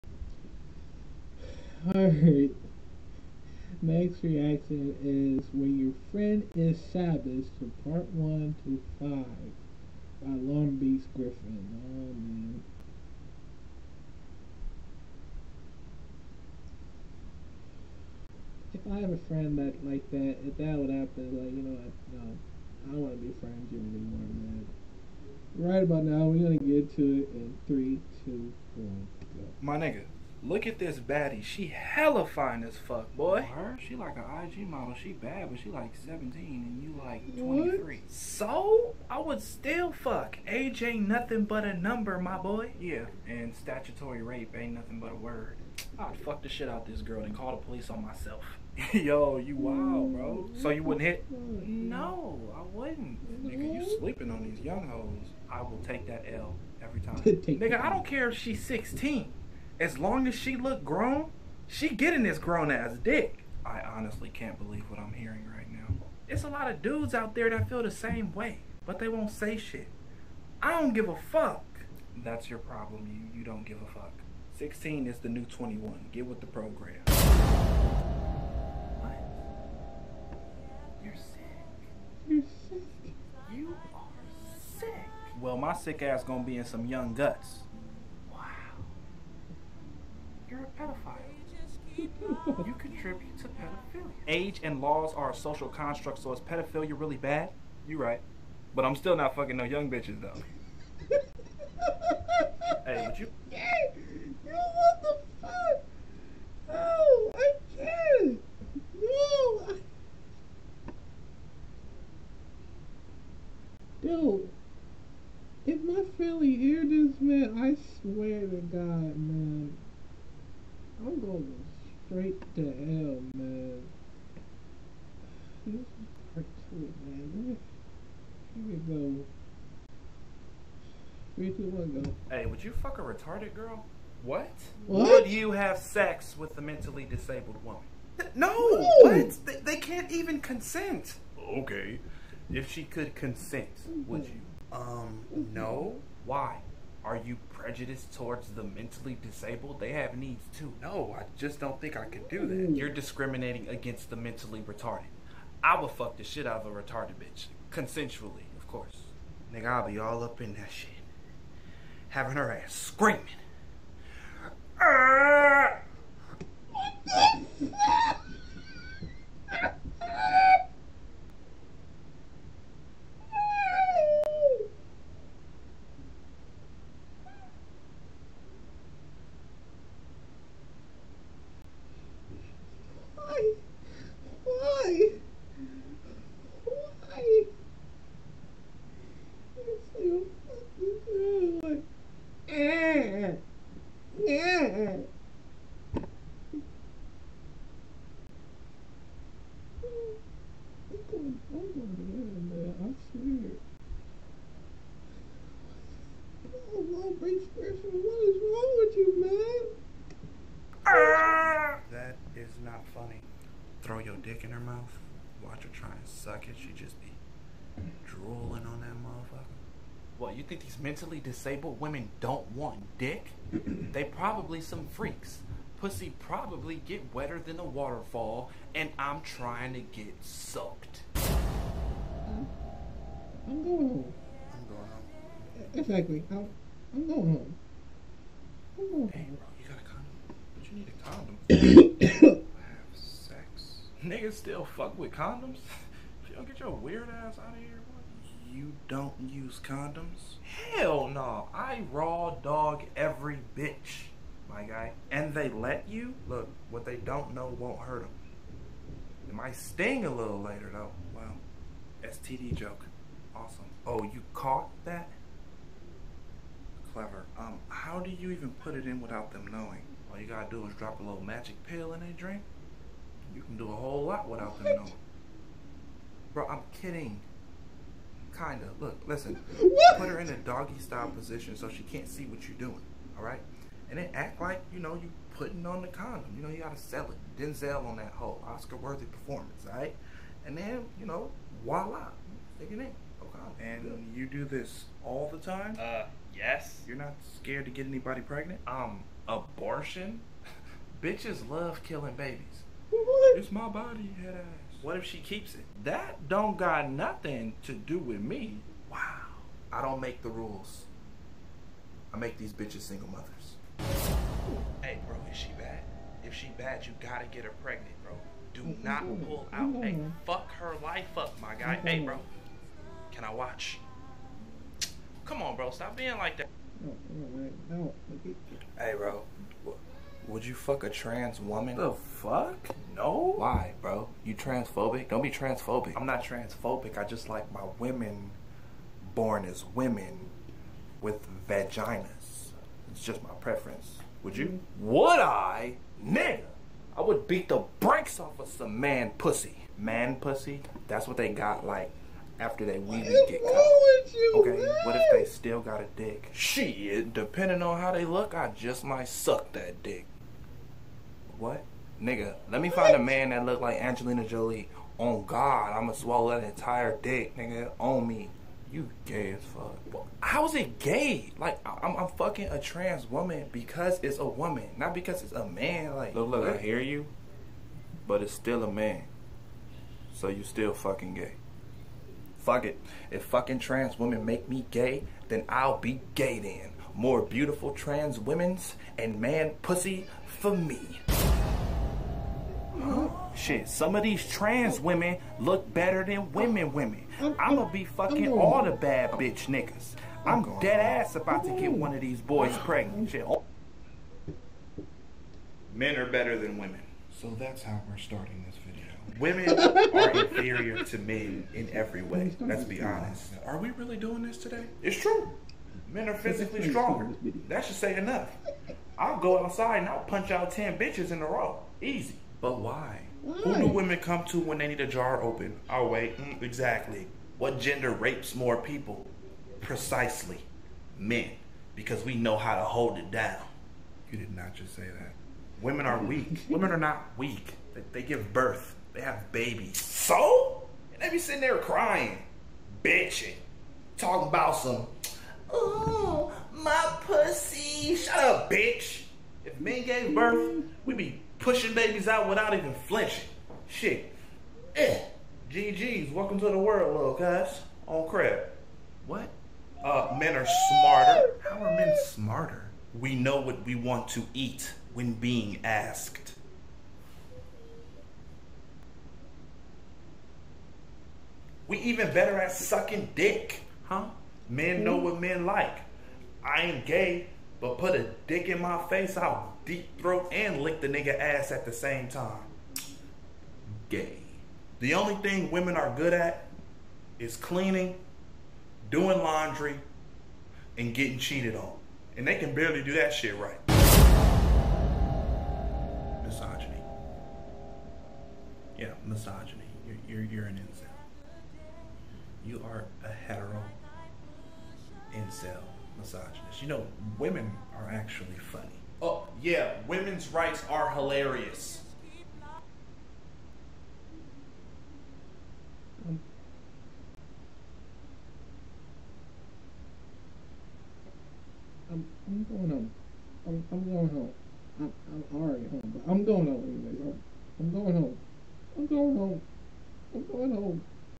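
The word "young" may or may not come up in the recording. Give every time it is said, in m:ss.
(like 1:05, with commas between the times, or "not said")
0:54, 1:26, 1:39.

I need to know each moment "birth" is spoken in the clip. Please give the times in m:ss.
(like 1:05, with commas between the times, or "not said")
7:18, 7:30.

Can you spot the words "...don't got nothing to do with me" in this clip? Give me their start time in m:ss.
5:06.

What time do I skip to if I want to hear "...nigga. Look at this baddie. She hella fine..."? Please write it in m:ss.
0:29.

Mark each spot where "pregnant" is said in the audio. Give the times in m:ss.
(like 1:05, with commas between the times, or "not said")
4:58, 5:17, 6:42.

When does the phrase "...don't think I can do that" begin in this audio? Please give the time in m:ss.
2:31.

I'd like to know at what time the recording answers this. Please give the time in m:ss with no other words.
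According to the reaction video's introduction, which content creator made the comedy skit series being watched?
0:10.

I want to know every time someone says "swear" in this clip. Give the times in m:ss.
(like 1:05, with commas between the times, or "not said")
1:57, 3:23.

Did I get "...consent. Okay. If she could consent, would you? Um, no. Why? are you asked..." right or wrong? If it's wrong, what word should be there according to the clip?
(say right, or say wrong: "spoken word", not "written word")
wrong: "prejudiced", not "asked".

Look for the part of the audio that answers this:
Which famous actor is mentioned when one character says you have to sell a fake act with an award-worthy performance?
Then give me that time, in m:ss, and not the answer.
4:47.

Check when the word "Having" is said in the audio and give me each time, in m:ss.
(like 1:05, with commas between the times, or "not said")
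2:42.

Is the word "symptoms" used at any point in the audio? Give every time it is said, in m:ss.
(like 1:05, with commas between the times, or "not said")
not said.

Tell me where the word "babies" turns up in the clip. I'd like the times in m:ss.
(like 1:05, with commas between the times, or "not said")
5:02, 7:19, 7:31.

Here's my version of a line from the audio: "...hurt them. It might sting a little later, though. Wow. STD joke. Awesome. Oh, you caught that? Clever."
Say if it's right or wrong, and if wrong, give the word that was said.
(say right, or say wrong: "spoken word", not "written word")
right.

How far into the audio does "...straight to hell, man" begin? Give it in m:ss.
2:02.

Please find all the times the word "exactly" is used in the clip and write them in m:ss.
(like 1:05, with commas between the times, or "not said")
3:55, 7:06.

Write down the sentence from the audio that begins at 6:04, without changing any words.
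Oh God, I'ma swallow that entire dick, nigga, on me.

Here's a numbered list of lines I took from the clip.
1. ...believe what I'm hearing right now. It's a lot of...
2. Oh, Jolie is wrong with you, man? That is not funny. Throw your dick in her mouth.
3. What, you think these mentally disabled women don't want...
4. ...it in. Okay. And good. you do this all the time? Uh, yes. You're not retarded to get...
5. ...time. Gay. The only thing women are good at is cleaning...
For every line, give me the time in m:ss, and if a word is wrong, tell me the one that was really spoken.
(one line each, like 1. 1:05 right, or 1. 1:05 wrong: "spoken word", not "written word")
1. 1:04 right
2. 3:26 wrong: "What", not "Jolie"
3. 3:40 right
4. 4:52 wrong: "scared", not "retarded"
5. 8:02 right.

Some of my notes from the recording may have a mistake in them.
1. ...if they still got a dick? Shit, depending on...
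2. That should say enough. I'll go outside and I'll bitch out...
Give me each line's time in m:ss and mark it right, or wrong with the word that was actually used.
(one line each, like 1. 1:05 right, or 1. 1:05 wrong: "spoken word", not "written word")
1. 5:54 right
2. 6:57 wrong: "punch", not "bitch".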